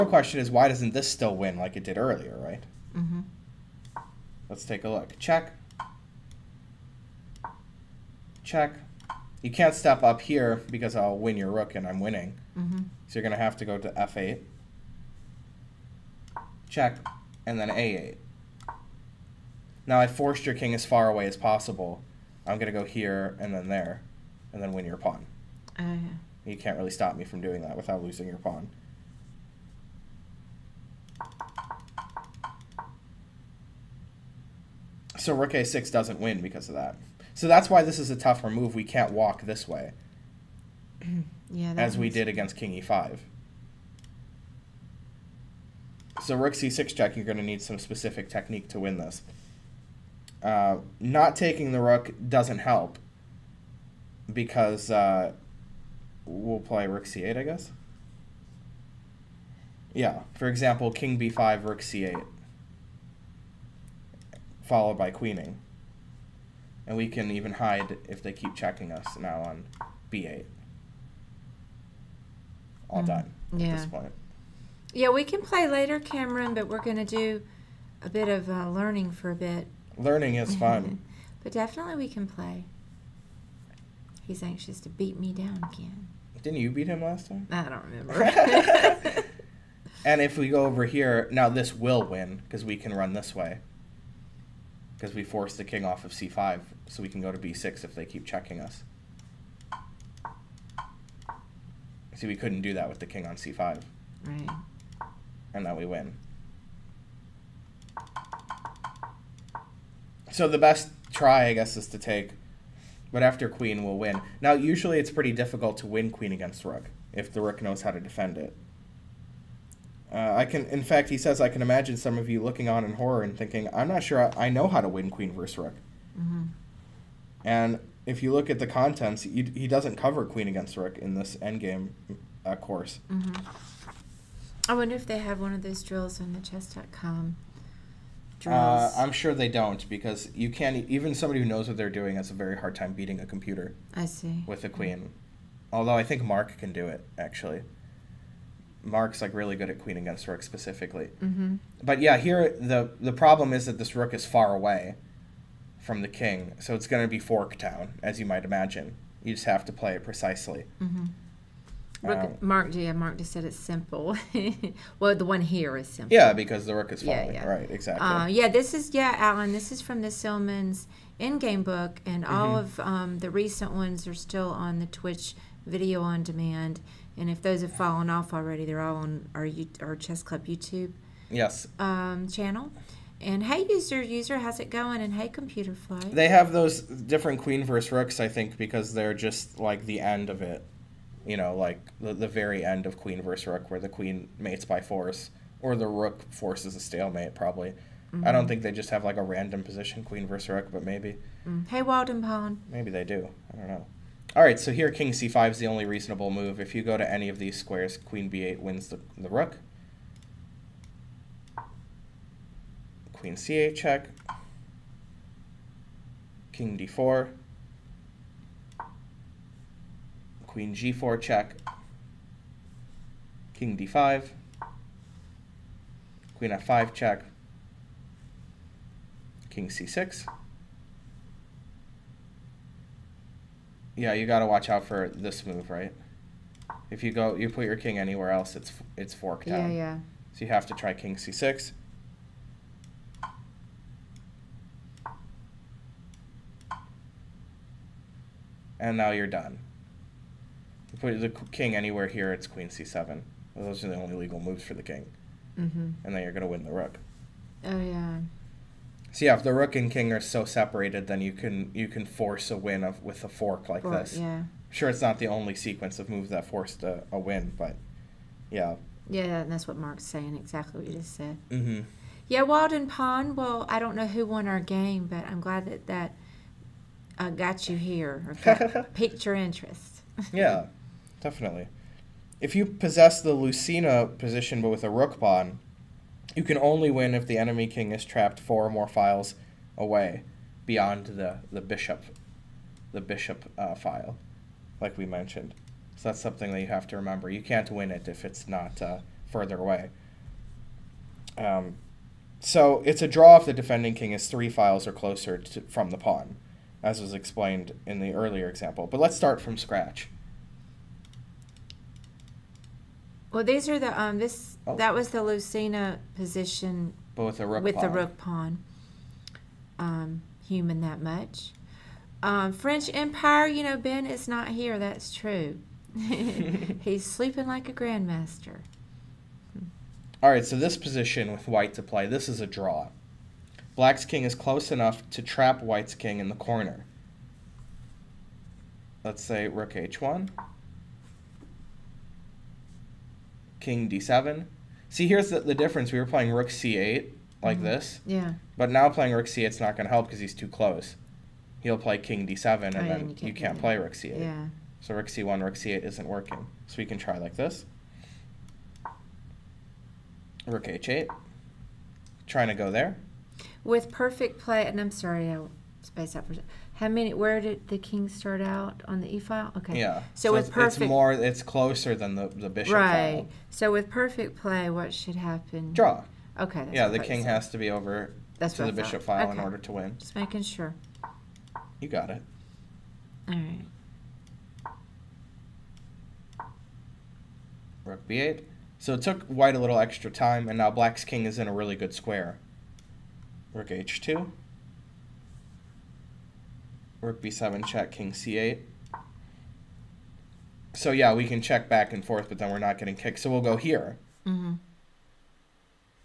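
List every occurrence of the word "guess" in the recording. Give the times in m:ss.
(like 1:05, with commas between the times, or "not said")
0:57, 1:51.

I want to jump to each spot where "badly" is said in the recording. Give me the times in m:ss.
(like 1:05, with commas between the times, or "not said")
not said.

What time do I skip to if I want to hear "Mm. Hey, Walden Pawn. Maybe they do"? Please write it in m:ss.
3:21.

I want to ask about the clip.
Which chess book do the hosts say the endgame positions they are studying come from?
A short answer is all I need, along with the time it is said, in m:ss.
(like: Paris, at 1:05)
Silman's endgame book, at 2:50.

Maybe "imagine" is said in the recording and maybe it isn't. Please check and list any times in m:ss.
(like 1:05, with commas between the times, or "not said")
2:01, 2:38.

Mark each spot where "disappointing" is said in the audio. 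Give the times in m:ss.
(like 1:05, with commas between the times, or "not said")
not said.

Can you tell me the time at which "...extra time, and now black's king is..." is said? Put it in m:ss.
6:29.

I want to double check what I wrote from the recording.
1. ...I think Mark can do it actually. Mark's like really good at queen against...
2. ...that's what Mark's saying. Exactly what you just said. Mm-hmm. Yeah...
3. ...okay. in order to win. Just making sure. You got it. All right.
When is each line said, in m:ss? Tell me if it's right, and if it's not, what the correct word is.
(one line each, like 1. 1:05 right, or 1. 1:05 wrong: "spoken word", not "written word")
1. 2:25 right
2. 4:29 right
3. 6:19 right.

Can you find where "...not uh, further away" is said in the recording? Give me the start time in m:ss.
4:58.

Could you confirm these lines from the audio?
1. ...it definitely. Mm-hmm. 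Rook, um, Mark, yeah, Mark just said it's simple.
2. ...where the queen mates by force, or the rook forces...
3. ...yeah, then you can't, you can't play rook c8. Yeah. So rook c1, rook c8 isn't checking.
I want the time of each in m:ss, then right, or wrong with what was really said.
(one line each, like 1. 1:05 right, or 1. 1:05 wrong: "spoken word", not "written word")
1. 2:39 wrong: "precisely", not "definitely"
2. 3:13 right
3. 5:52 wrong: "working", not "checking".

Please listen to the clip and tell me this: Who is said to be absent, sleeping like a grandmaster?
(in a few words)
Ben.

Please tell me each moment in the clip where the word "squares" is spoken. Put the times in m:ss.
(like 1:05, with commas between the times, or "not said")
3:27, 6:31.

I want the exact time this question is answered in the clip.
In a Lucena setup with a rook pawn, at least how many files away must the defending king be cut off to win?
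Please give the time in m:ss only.
4:48.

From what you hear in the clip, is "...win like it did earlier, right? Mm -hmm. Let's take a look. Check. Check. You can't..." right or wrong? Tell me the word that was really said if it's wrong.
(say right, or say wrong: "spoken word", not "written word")
right.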